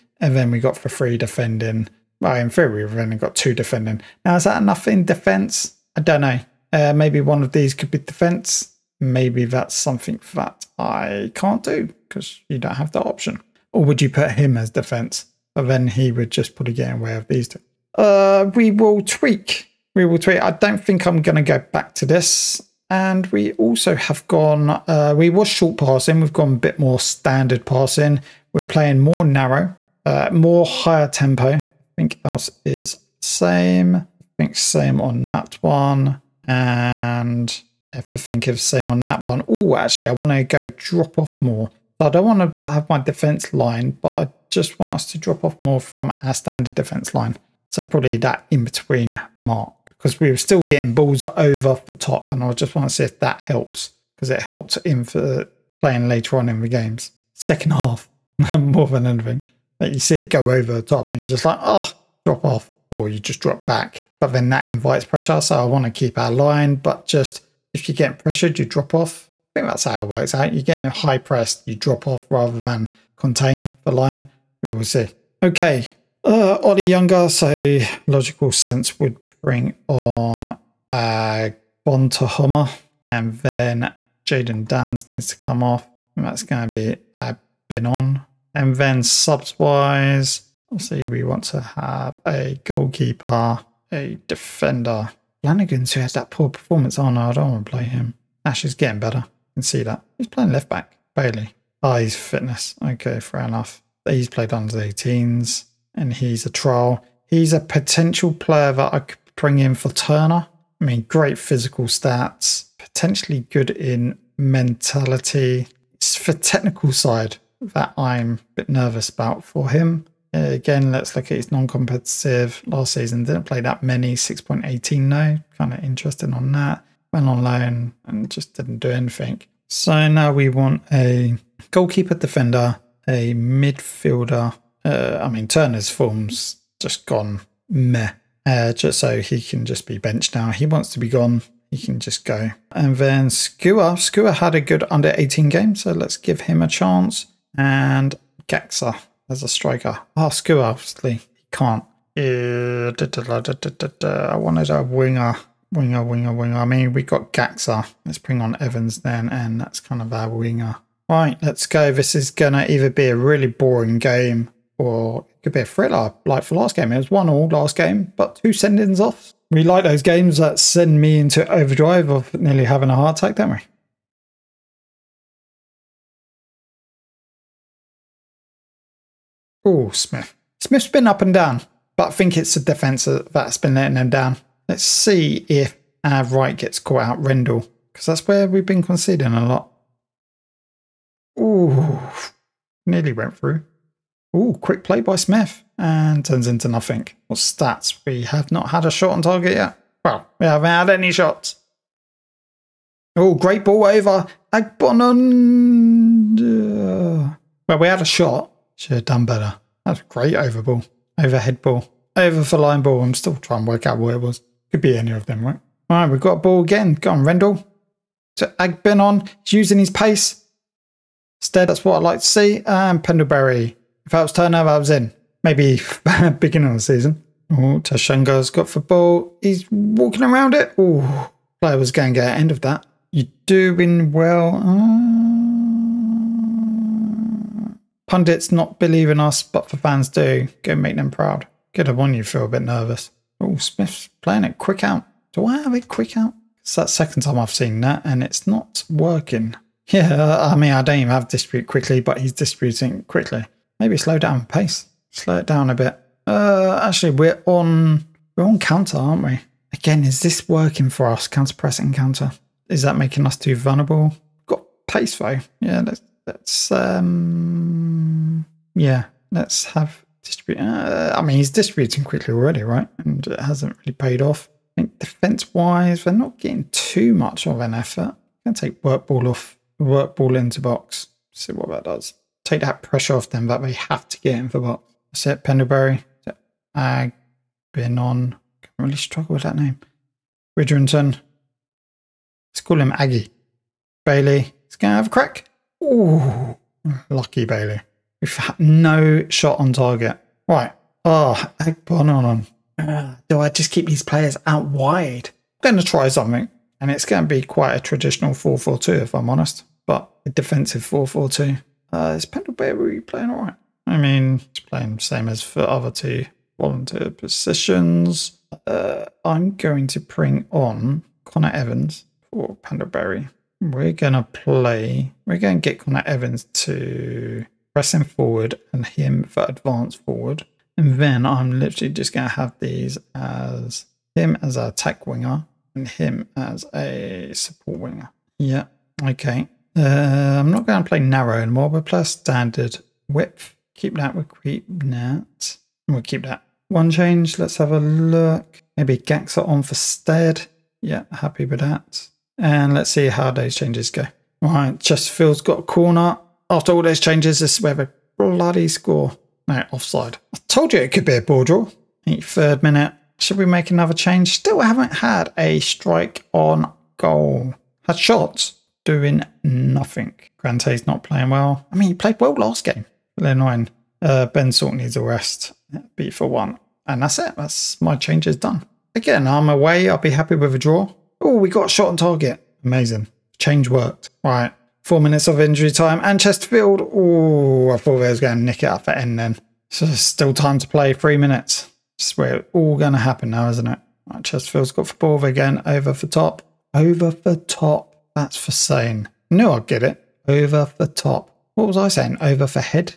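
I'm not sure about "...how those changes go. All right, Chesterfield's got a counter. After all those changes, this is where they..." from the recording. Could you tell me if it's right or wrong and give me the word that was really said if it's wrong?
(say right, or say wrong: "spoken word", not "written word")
wrong: "corner", not "counter".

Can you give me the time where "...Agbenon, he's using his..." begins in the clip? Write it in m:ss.
3:38.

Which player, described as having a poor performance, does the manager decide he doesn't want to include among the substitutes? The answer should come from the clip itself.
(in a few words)
Flanagan.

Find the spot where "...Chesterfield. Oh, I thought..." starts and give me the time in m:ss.
6:26.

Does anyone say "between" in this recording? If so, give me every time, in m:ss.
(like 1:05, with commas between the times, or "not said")
0:48.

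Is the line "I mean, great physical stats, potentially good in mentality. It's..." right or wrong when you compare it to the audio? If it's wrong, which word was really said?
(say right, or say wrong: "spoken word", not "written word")
right.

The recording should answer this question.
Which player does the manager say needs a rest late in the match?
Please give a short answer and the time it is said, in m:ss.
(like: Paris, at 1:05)
Ben Salt, at 6:14.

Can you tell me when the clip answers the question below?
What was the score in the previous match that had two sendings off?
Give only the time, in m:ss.
2:47.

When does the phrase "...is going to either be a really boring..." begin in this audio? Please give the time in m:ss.
2:42.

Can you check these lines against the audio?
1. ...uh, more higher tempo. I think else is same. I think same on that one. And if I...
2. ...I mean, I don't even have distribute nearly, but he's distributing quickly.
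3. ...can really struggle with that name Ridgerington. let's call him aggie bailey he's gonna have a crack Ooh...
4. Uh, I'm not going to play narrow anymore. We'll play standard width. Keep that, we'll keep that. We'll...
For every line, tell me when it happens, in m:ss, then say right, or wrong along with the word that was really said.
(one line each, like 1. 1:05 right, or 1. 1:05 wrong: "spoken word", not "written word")
1. 0:30 right
2. 4:10 wrong: "quickly", not "nearly"
3. 4:48 right
4. 5:39 right.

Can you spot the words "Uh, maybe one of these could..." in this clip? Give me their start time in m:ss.
0:06.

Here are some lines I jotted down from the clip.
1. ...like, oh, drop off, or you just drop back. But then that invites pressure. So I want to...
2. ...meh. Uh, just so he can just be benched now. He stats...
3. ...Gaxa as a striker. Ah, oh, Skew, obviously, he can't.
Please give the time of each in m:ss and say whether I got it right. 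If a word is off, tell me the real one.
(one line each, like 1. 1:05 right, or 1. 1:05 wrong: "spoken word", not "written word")
1. 1:01 right
2. 2:17 wrong: "wants", not "stats"
3. 2:28 right.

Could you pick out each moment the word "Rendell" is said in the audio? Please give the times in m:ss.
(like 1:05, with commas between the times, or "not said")
3:07, 3:37.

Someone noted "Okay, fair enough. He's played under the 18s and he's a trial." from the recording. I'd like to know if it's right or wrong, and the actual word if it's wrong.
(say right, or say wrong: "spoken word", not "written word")
right.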